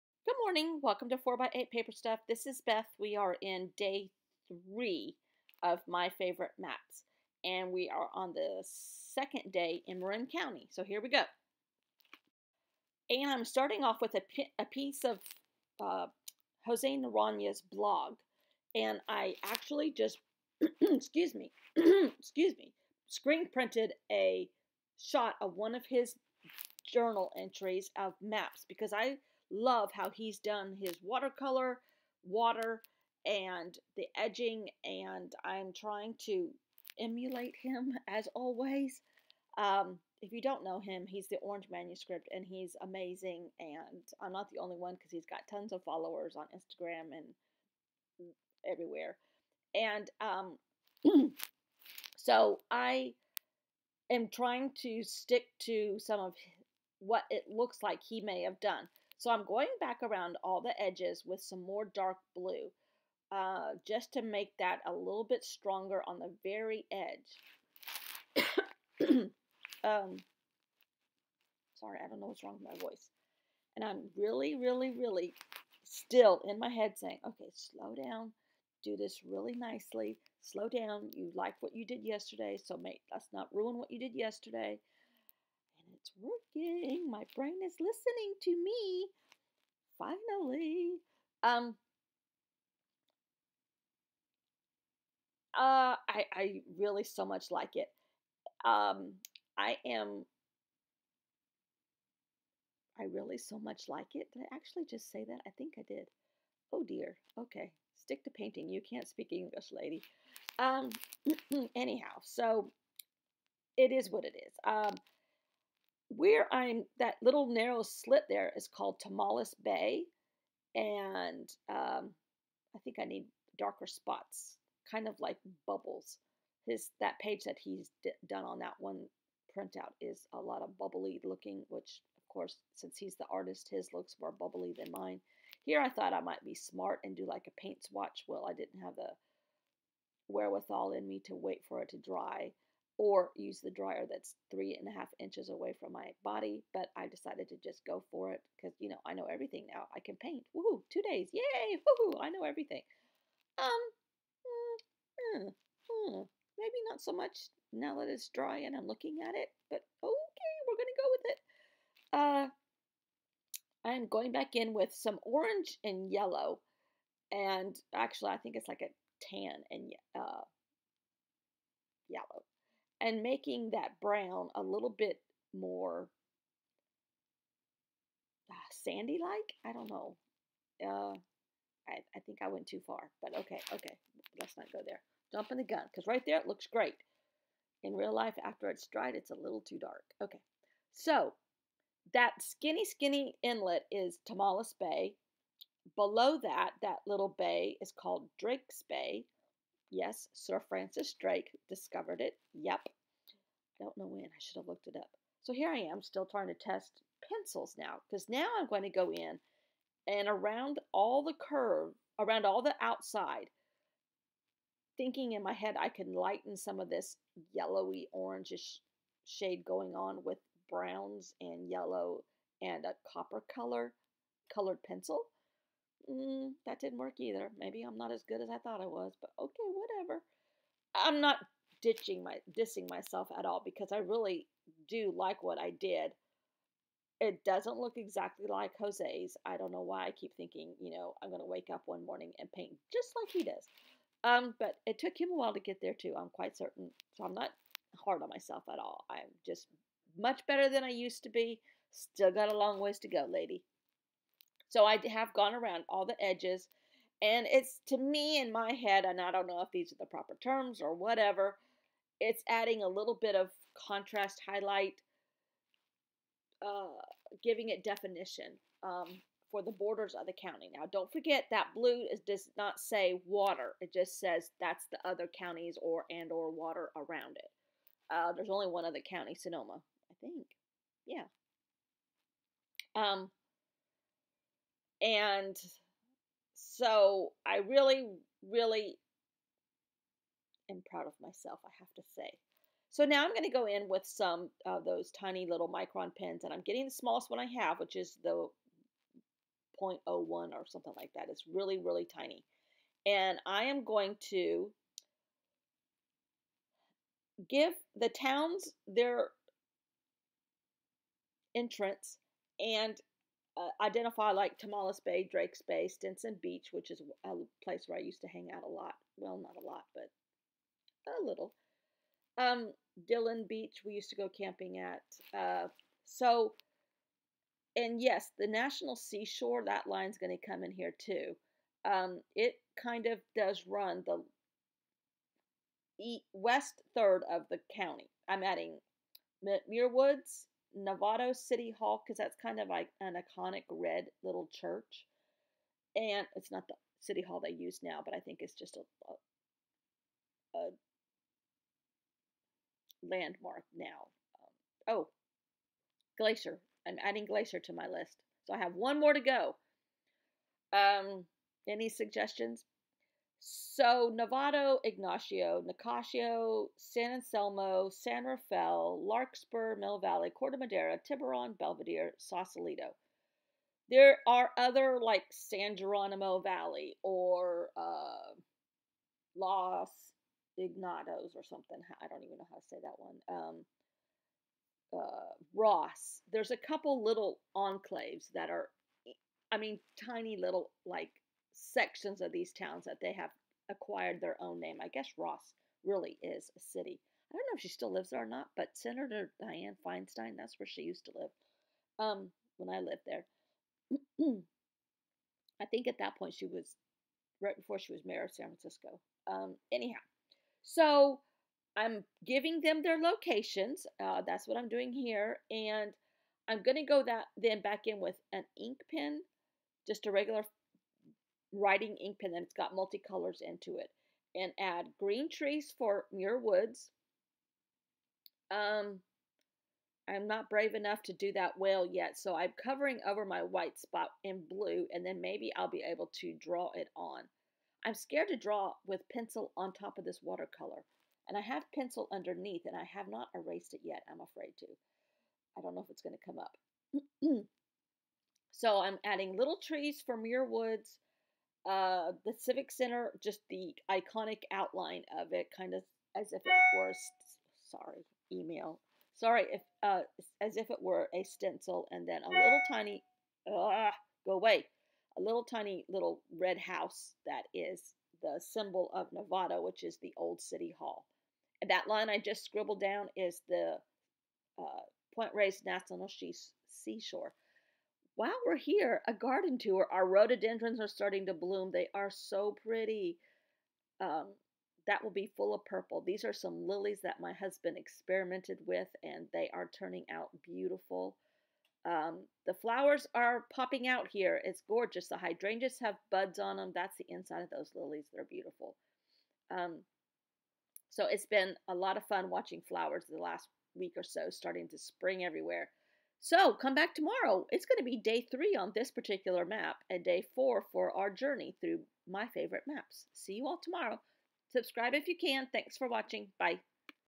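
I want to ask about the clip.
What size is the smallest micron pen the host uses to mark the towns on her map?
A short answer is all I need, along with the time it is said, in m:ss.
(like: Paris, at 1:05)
0.01, at 4:59.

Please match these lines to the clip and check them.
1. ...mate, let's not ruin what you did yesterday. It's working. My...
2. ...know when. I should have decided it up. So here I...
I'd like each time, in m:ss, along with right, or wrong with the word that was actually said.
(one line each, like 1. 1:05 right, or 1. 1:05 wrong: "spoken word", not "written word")
1. 1:22 right
2. 3:23 wrong: "looked", not "decided".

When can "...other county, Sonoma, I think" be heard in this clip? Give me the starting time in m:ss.
4:38.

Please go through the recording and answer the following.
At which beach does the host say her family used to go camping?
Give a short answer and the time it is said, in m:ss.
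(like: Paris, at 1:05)
Dillon Beach, at 5:23.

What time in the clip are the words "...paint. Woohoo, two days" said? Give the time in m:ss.
2:30.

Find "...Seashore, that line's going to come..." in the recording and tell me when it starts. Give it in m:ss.
5:28.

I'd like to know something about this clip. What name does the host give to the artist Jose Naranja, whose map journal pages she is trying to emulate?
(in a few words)
The Orange Manuscript.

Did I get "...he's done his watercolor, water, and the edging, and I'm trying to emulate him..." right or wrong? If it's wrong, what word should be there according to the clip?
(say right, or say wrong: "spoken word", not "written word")
right.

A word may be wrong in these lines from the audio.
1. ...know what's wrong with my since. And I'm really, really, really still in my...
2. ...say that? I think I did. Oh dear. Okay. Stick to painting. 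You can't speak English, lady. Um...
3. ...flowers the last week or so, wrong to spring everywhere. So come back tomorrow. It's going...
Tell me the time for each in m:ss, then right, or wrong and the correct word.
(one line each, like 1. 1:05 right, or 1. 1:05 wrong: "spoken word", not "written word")
1. 1:12 wrong: "voice", not "since"
2. 1:45 right
3. 8:22 wrong: "starting", not "wrong".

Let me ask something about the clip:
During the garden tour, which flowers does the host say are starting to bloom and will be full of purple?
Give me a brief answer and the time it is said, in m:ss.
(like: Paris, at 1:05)
Rhododendrons, at 8:00.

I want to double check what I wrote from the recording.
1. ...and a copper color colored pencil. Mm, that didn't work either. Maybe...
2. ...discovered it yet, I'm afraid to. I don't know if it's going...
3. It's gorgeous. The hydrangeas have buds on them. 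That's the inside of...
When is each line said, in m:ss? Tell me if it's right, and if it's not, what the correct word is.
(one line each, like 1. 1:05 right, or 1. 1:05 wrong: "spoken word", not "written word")
1. 3:42 right
2. 7:23 wrong: "erased", not "discovered"
3. 8:14 right.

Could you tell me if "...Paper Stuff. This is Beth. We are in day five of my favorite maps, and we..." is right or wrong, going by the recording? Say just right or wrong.
wrong.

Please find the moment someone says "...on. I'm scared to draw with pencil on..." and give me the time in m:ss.
7:16.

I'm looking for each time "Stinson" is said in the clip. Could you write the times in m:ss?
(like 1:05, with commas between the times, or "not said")
5:15.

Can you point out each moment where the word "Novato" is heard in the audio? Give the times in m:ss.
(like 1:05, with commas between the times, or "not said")
5:40, 6:04, 7:49.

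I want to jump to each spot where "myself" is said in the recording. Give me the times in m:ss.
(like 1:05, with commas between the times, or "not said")
3:52, 4:08, 4:51.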